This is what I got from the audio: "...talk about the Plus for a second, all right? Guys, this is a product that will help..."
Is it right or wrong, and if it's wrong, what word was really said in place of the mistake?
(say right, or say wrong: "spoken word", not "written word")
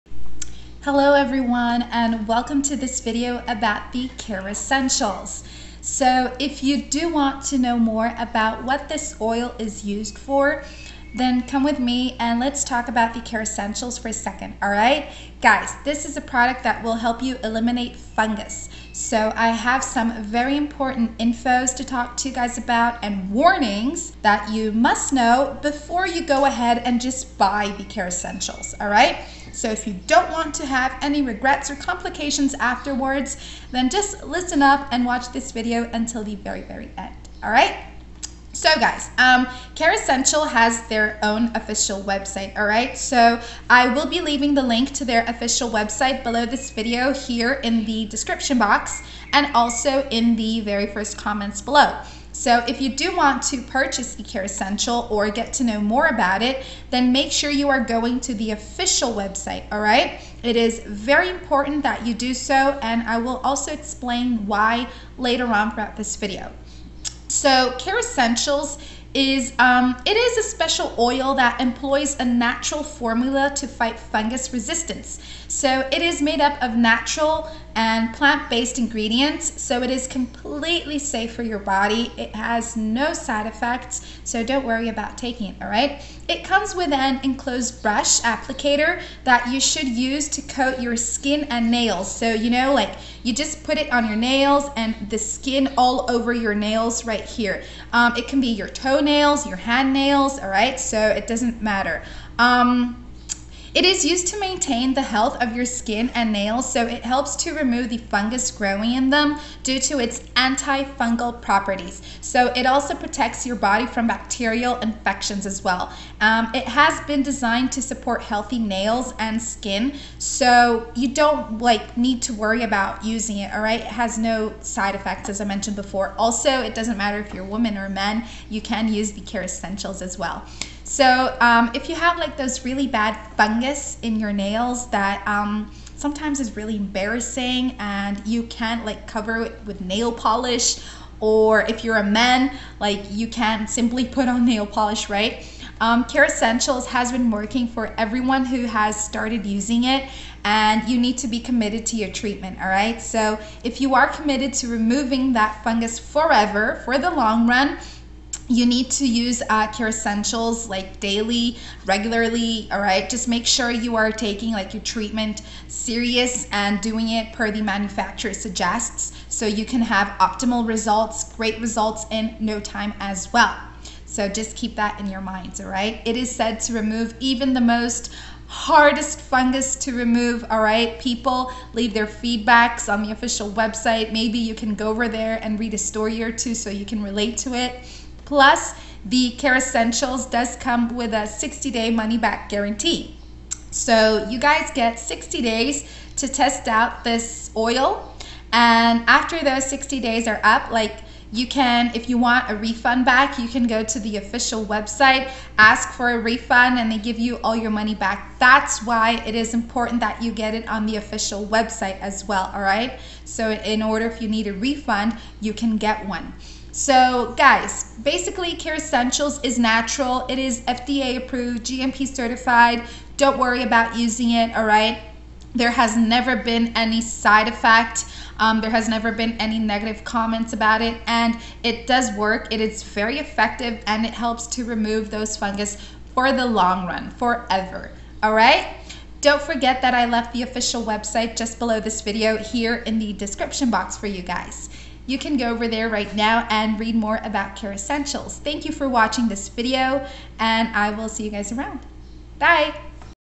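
wrong: "Kerassentials", not "Plus".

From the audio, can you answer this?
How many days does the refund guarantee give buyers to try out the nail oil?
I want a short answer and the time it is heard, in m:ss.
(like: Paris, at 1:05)
60, at 3:11.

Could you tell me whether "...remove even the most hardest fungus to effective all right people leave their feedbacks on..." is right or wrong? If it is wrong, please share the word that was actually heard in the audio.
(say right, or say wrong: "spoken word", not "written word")
wrong: "remove", not "effective".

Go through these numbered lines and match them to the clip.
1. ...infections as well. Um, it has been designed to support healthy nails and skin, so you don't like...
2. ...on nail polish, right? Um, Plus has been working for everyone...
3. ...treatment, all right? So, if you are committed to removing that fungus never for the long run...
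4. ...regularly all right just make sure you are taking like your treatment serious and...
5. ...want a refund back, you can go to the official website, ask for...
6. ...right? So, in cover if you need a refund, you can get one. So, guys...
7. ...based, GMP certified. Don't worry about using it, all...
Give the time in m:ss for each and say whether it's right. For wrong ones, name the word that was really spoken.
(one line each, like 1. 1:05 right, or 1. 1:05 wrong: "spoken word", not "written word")
1. 1:54 right
2. 2:24 wrong: "Kerassentials", not "Plus"
3. 2:32 wrong: "forever", not "never"
4. 2:41 right
5. 3:22 right
6. 3:32 wrong: "order", not "cover"
7. 3:41 wrong: "approved", not "based".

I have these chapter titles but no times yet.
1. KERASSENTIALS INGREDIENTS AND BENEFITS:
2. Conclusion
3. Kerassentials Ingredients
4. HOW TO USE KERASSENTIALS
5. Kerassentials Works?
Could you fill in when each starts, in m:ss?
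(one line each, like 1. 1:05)
1. 0:15
2. 3:57
3. 1:10
4. 1:30
5. 2:50.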